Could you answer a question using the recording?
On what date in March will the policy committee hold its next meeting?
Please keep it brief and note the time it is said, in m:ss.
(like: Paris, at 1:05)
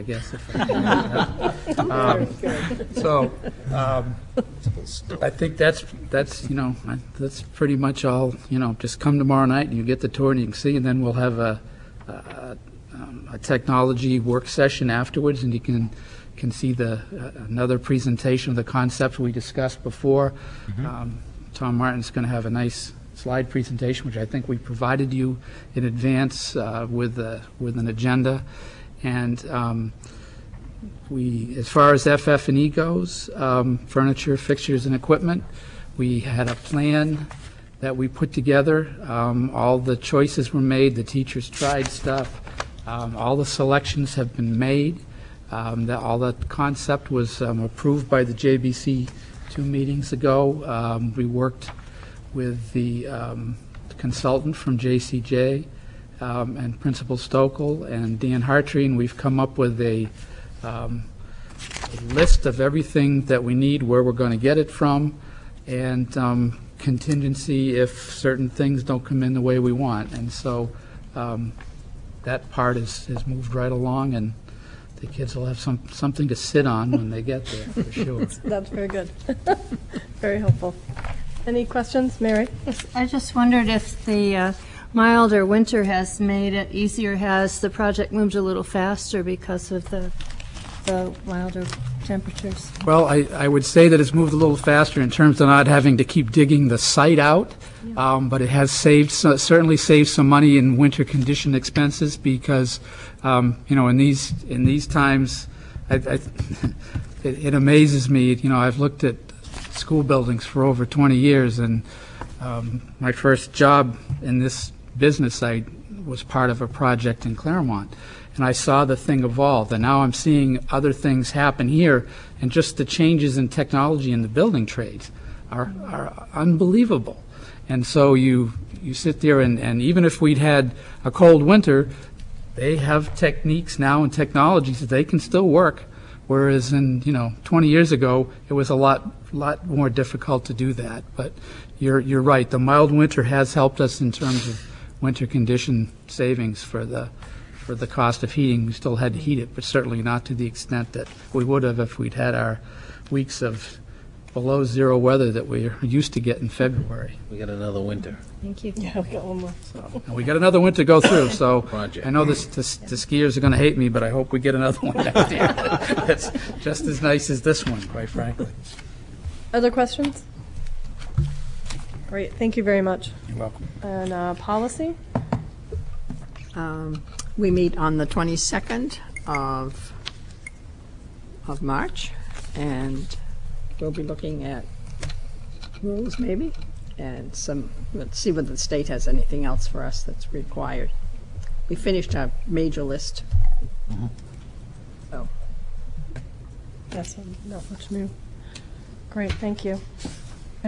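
22nd, at 2:58.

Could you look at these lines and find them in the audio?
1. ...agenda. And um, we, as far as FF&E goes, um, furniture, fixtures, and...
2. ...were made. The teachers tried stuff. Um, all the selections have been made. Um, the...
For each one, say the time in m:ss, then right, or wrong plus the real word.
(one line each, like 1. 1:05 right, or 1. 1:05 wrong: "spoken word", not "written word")
1. 0:27 right
2. 0:40 right.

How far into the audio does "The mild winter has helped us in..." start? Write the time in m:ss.
2:22.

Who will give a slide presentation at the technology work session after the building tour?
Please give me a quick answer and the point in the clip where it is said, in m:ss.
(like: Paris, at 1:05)
Tom Martin, at 0:21.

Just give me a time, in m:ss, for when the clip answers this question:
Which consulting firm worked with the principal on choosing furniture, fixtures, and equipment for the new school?
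0:54.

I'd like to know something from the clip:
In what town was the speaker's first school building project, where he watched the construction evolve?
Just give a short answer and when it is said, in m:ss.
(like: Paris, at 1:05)
Claremont, at 1:57.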